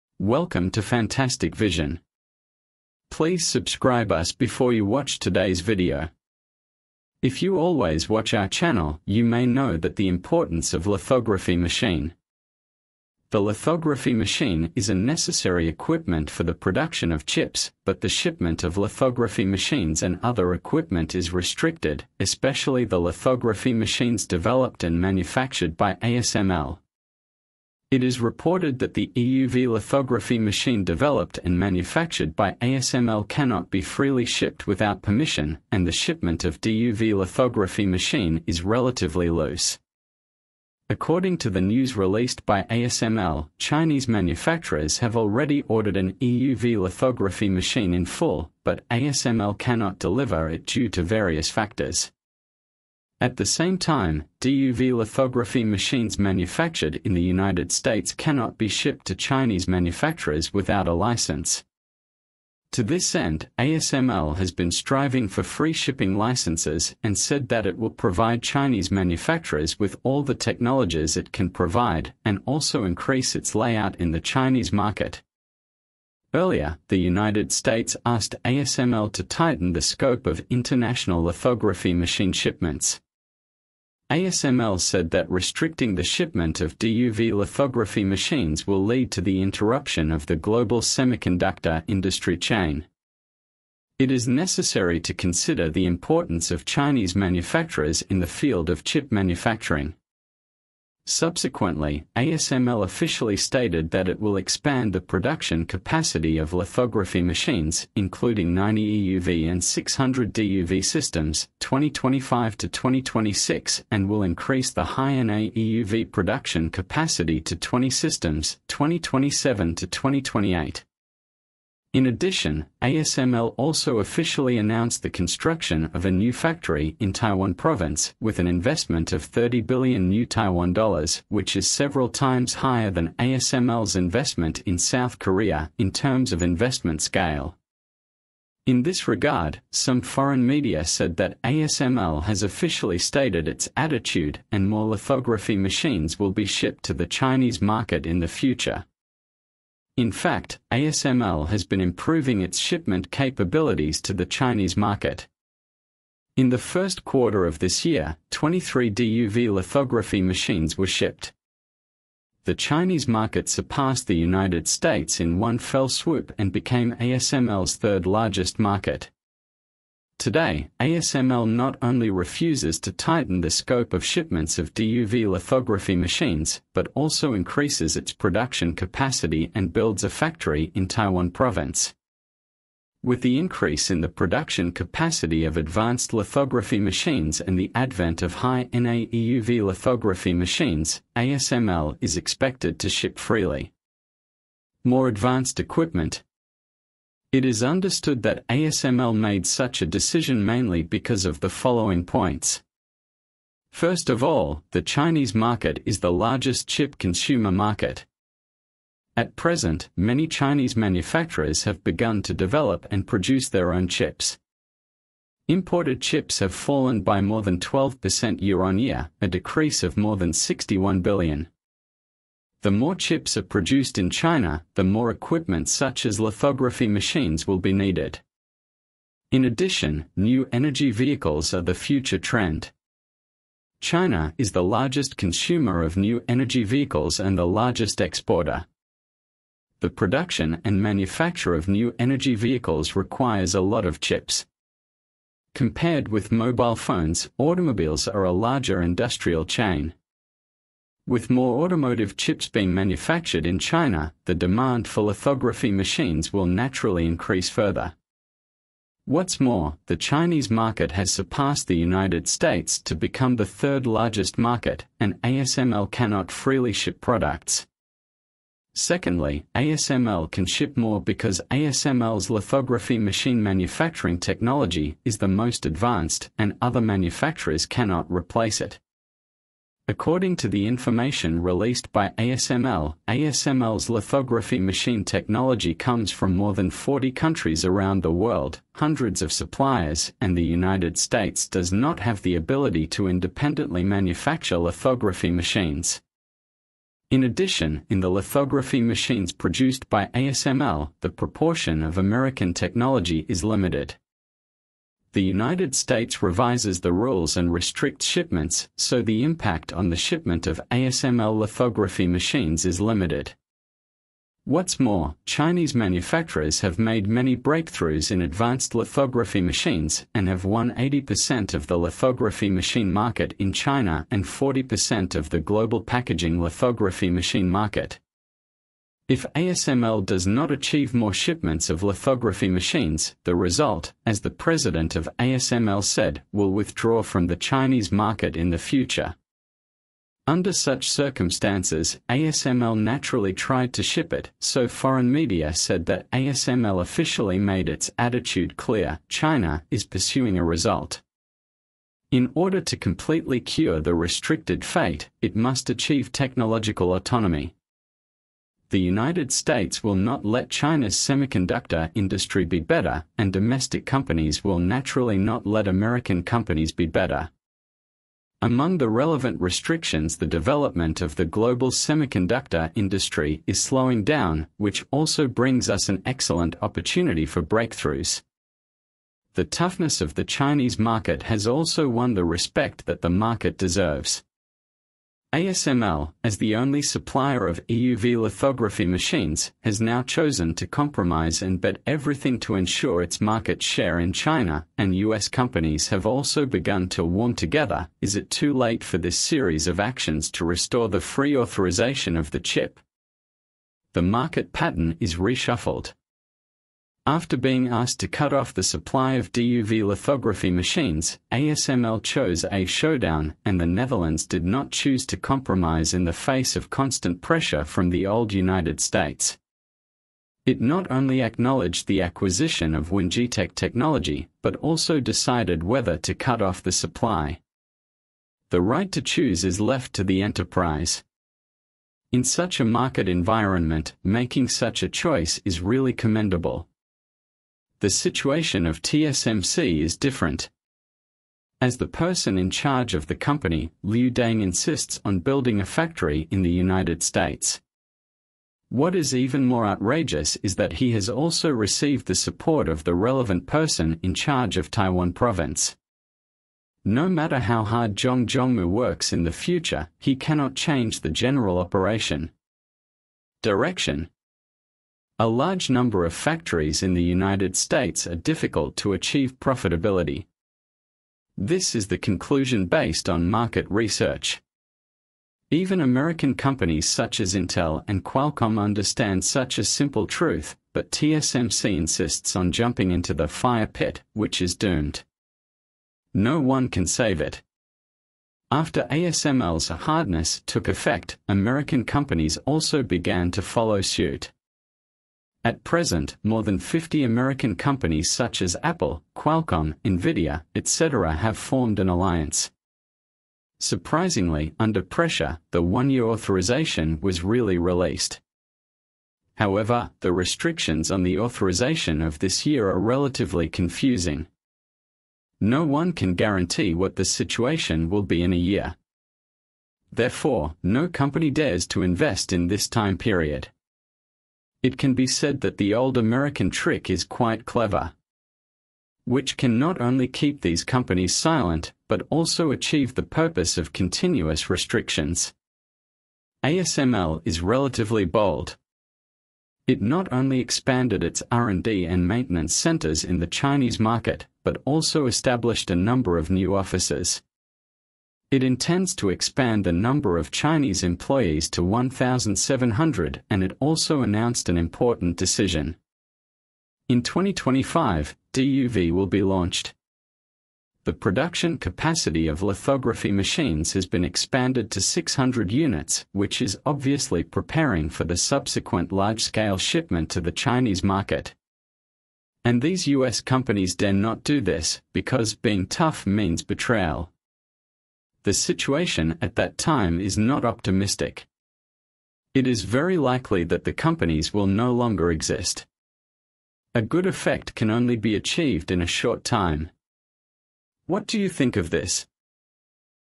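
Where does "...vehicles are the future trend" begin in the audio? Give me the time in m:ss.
3:50.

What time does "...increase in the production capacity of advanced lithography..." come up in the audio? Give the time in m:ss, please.
3:03.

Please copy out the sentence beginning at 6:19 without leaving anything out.
The toughness of the Chinese market has also won the respect that the market deserves.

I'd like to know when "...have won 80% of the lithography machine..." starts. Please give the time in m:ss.
5:20.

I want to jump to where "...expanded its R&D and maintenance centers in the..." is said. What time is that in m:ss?
9:00.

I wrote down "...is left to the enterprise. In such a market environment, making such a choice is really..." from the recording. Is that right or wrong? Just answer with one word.
right.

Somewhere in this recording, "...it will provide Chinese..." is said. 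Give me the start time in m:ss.
1:07.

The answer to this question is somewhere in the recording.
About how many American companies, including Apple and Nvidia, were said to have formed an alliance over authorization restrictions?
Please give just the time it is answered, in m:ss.
8:16.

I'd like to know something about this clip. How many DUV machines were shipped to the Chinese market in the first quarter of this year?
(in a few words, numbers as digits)
23.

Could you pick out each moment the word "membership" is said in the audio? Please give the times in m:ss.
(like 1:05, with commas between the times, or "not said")
not said.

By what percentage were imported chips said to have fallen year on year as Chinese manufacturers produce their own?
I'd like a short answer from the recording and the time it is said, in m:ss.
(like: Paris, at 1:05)
12%, at 3:37.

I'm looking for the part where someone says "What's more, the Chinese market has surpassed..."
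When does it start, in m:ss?
4:19.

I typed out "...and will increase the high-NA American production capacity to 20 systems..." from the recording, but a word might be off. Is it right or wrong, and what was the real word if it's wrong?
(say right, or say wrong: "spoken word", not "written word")
wrong: "EUV", not "American".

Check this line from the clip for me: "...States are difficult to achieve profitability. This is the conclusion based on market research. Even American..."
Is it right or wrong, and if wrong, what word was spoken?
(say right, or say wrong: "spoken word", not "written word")
right.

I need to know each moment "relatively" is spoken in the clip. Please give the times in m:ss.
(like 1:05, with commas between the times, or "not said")
0:38, 8:32, 8:57.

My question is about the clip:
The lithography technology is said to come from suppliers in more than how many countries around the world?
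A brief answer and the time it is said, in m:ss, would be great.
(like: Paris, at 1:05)
40, at 4:46.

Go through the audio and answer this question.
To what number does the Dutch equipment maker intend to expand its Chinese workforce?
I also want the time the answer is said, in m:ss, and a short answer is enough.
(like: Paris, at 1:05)
1,700, at 9:11.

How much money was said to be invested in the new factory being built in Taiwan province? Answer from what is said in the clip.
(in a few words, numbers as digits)
30 billion new Taiwan dollars.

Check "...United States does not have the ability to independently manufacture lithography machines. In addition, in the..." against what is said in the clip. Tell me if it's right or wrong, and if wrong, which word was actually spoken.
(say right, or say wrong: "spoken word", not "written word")
right.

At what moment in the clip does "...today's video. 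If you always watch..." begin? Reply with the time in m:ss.
0:05.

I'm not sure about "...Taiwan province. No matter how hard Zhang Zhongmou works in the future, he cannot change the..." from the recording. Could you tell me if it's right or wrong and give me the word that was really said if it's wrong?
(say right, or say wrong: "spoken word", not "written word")
right.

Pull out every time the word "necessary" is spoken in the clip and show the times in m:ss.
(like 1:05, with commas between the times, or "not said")
0:14, 1:34.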